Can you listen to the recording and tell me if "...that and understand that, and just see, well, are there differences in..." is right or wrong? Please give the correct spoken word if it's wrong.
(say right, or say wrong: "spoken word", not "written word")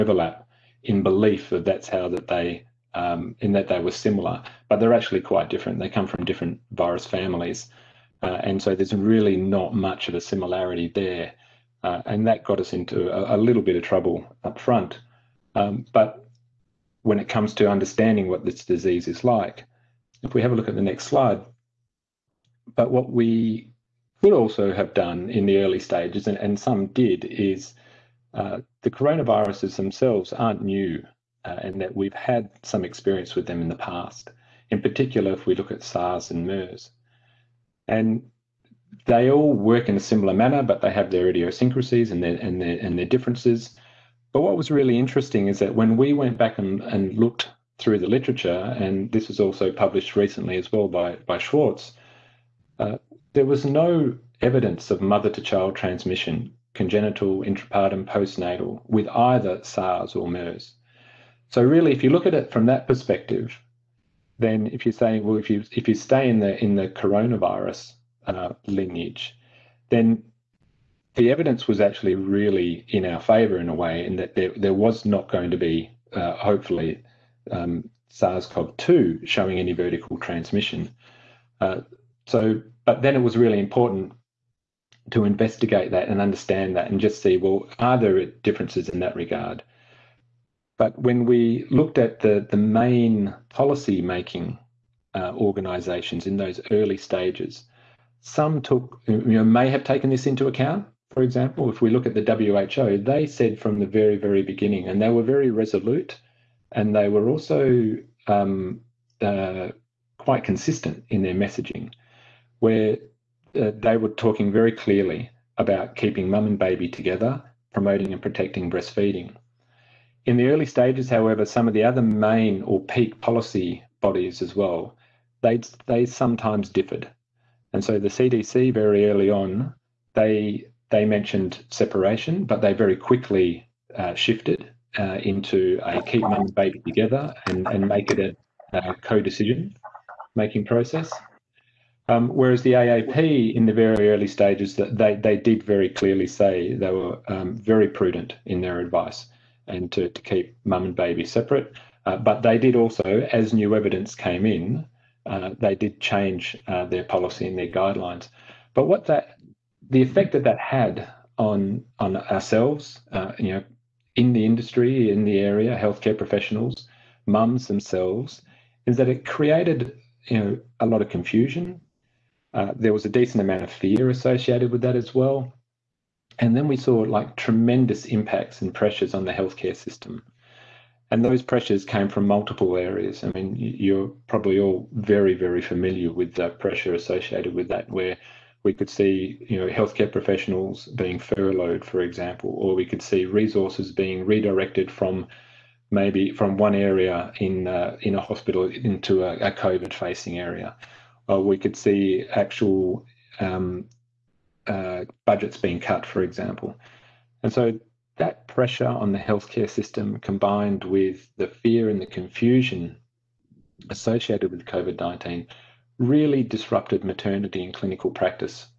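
right.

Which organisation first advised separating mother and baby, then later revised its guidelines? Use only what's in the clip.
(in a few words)
AAP.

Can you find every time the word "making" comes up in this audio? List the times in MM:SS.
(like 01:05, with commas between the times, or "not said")
01:33, 02:20.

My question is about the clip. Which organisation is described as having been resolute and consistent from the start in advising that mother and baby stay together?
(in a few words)
WHO.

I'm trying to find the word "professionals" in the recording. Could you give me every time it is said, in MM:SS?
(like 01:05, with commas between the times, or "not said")
02:46, 03:10.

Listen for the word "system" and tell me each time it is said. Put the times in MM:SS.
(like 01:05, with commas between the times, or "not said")
02:59, 03:29.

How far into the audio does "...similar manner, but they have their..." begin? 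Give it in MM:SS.
00:39.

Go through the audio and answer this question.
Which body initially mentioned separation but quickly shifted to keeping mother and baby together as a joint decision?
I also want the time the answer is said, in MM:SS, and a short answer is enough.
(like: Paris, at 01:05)
CDC, at 02:08.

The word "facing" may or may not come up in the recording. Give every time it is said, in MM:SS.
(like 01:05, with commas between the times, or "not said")
03:19.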